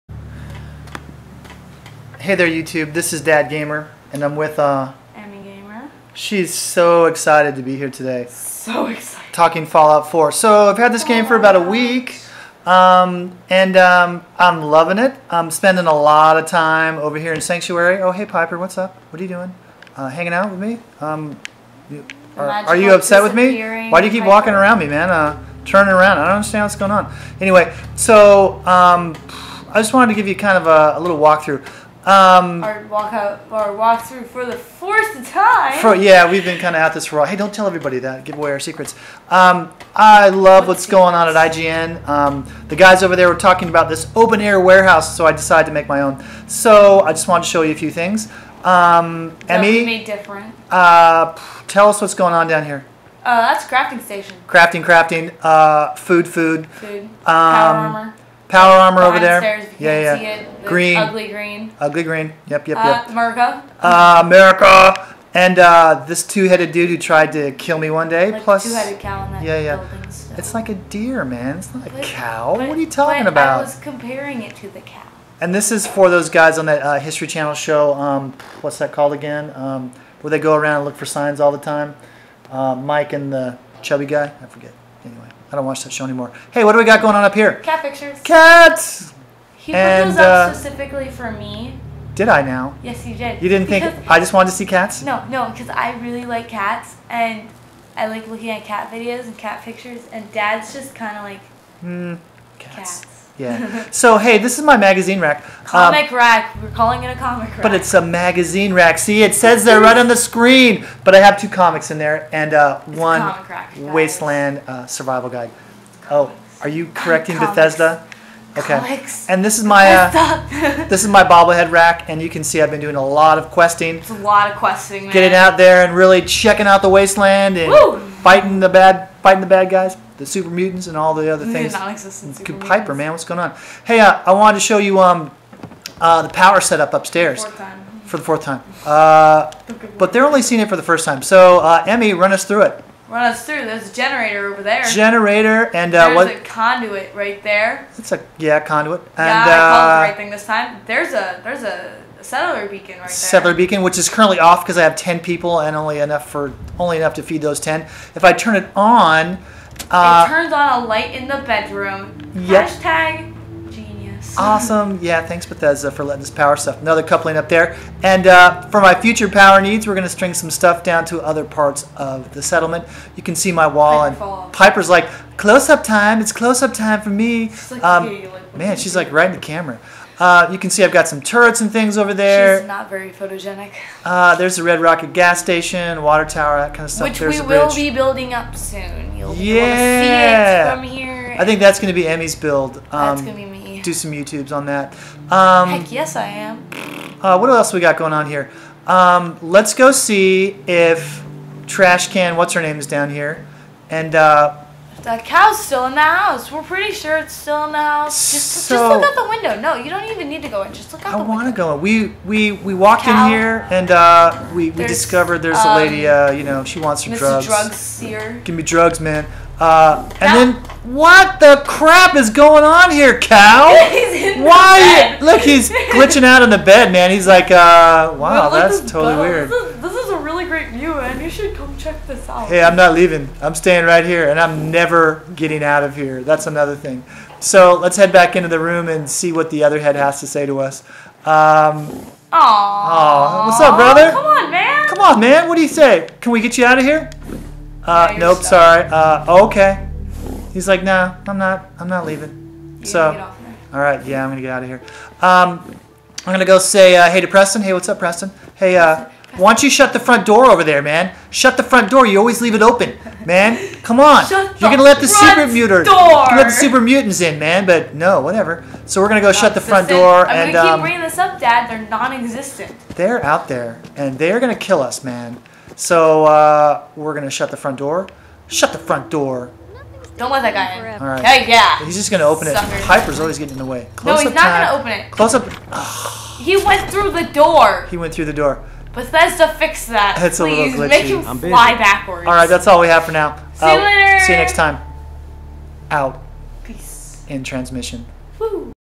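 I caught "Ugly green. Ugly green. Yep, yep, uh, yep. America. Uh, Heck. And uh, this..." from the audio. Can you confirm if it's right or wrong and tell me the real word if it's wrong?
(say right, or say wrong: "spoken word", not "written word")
wrong: "America", not "Heck".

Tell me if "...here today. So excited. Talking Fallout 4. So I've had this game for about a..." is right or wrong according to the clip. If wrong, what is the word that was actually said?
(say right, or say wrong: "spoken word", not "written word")
right.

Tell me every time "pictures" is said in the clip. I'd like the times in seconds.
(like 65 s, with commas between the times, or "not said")
87 s, 99 s.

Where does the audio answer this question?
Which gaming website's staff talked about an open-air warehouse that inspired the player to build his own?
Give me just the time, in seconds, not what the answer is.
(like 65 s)
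41 s.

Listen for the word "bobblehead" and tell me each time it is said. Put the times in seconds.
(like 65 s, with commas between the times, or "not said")
121 s.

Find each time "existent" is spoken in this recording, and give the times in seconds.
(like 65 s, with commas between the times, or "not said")
131 s, 271 s.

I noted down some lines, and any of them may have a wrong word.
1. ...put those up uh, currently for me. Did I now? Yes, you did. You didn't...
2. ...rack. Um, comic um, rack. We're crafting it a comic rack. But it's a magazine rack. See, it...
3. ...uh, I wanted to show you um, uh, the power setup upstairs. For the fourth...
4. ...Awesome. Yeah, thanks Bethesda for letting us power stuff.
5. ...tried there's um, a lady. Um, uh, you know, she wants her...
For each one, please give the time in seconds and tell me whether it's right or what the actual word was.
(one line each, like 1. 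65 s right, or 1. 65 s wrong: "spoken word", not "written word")
1. 89 s wrong: "specifically", not "currently"
2. 105 s wrong: "calling", not "crafting"
3. 133 s right
4. 164 s right
5. 214 s wrong: "discovered", not "tried".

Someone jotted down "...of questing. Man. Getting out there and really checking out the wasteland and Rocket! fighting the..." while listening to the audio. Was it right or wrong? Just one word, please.
wrong.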